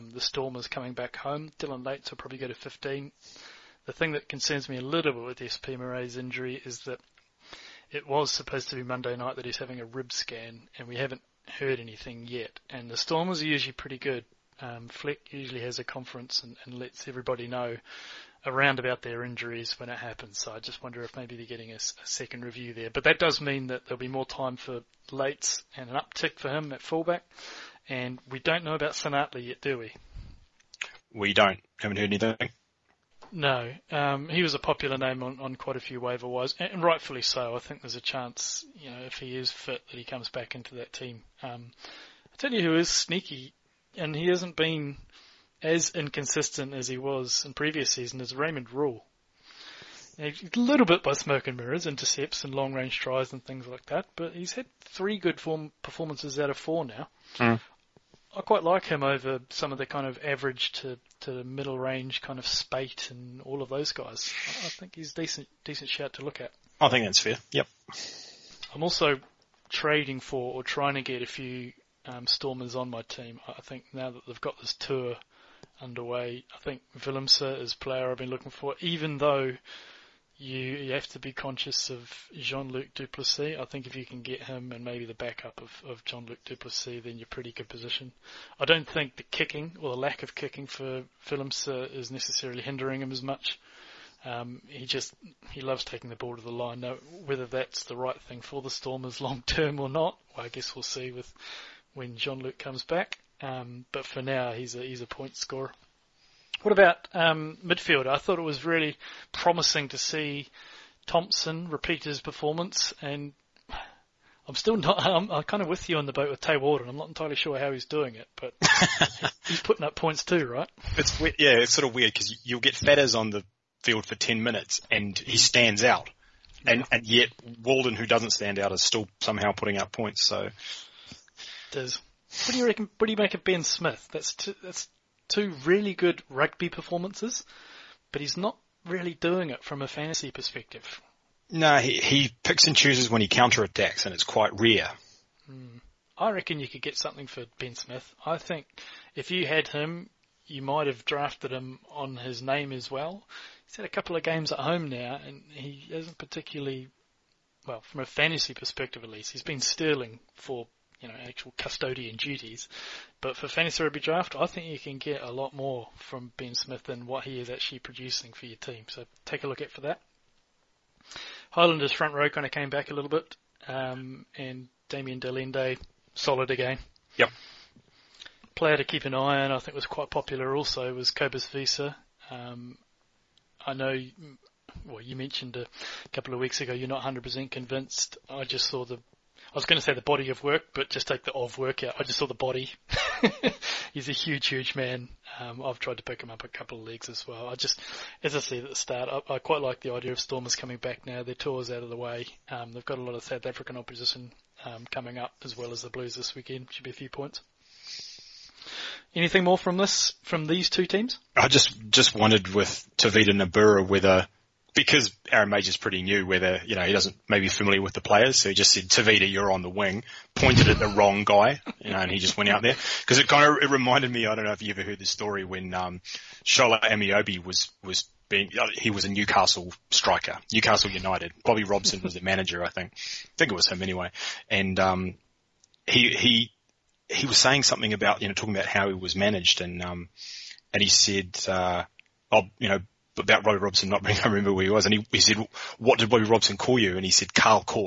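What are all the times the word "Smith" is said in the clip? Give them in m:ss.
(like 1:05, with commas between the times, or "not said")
2:13, 2:27, 2:46.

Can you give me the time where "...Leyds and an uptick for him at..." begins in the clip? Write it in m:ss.
0:25.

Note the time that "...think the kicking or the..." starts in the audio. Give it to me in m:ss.
1:28.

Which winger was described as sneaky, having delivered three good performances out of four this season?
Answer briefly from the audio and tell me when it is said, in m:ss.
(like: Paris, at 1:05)
Raymond Rhule, at 0:48.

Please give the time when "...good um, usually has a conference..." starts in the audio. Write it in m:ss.
0:13.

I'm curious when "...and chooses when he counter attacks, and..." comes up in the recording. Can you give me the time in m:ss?
2:22.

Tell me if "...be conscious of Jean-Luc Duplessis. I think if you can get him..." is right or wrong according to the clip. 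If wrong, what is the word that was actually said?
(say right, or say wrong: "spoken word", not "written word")
right.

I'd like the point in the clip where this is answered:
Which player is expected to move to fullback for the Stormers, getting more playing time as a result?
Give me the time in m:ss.
0:01.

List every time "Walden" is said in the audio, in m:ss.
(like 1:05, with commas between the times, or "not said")
1:56, 2:07.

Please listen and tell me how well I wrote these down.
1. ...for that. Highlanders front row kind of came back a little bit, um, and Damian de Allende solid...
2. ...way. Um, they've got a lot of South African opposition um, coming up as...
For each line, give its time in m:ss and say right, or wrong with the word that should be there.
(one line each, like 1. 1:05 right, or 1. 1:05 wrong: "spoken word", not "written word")
1. 2:49 right
2. 3:21 right.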